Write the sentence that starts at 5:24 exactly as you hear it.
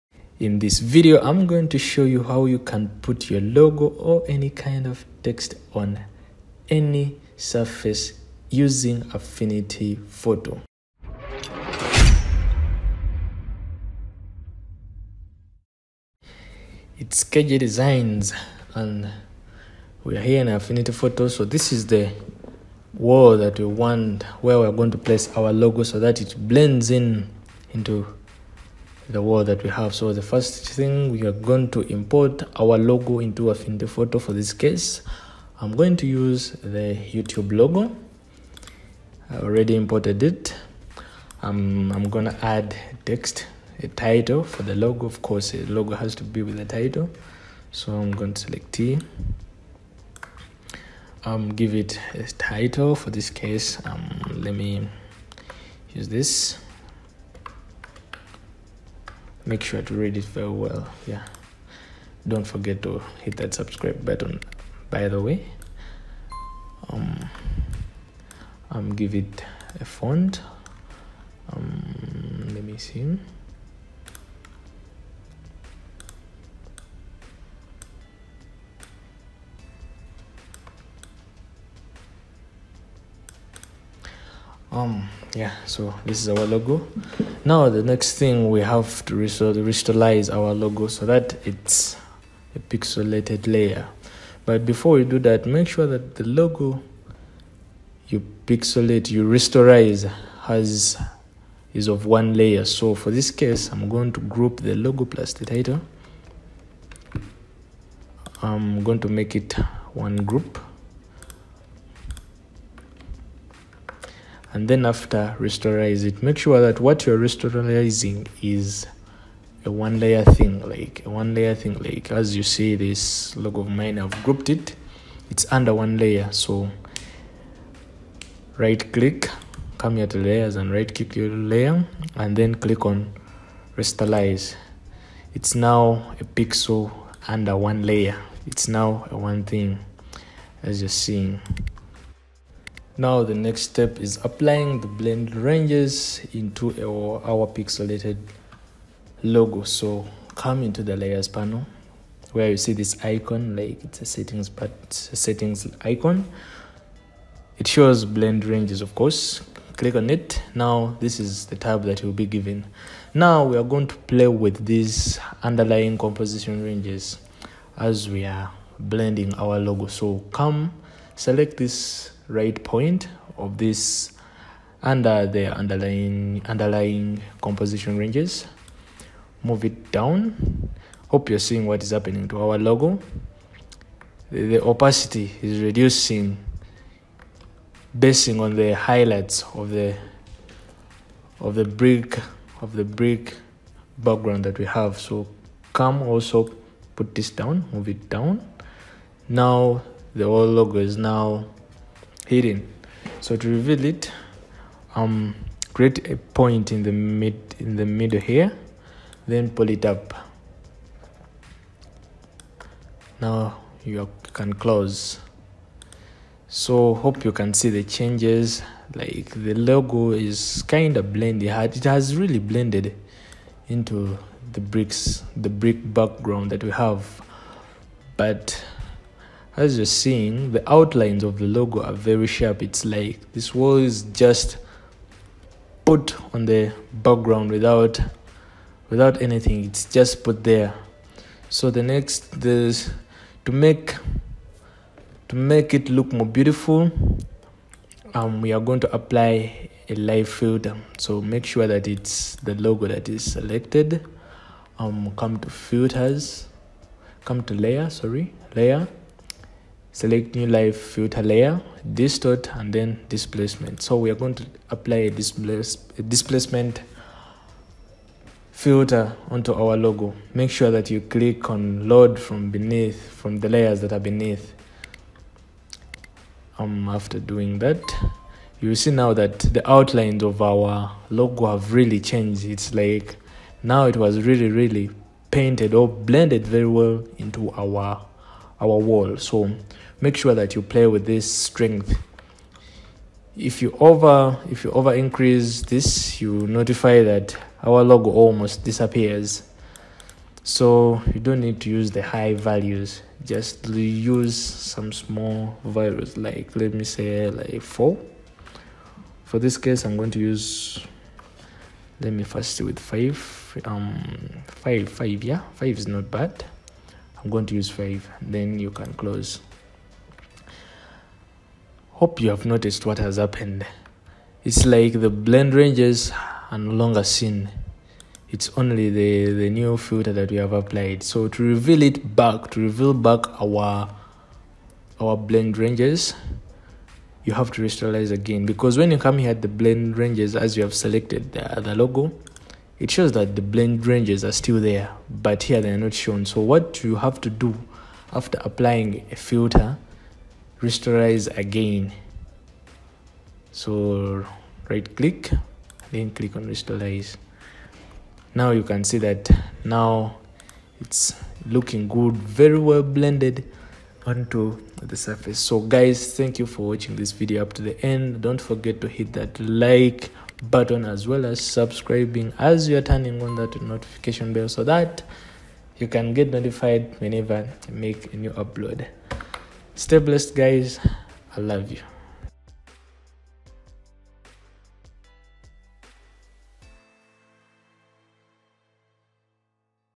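It's like the blend ranges are no longer seen.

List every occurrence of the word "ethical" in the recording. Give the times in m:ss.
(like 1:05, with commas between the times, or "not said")
not said.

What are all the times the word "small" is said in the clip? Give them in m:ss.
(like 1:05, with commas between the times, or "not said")
5:04.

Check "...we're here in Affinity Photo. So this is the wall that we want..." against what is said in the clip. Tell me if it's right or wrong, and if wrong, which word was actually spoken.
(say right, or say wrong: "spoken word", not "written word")
right.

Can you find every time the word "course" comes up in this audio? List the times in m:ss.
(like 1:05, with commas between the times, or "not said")
0:45, 2:38.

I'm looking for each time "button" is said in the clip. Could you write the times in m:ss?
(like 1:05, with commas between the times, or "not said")
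1:04, 6:10.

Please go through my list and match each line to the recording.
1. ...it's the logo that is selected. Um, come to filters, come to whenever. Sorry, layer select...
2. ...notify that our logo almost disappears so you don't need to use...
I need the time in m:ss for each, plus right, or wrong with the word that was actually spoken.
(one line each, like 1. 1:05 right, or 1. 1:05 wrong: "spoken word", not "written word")
1. 4:11 wrong: "layer", not "whenever"
2. 4:56 right.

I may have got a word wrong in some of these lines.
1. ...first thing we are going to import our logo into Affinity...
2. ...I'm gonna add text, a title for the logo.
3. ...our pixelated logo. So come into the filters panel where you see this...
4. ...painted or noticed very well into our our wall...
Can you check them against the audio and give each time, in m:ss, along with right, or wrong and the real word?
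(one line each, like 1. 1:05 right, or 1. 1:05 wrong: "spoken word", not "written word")
1. 0:30 right
2. 0:41 right
3. 2:27 wrong: "layers", not "filters"
4. 4:45 wrong: "blended", not "noticed".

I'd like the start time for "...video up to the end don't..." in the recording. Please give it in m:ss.
6:07.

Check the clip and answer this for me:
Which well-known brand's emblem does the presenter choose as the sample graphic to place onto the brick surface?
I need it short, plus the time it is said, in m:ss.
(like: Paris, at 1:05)
YouTube, at 0:36.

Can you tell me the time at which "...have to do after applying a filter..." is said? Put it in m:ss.
5:46.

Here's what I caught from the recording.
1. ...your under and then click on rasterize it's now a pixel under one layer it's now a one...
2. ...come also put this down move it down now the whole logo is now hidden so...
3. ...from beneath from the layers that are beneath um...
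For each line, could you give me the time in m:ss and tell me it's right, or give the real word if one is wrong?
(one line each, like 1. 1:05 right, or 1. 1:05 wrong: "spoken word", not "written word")
1. 2:11 wrong: "layer", not "under"
2. 3:15 right
3. 4:32 right.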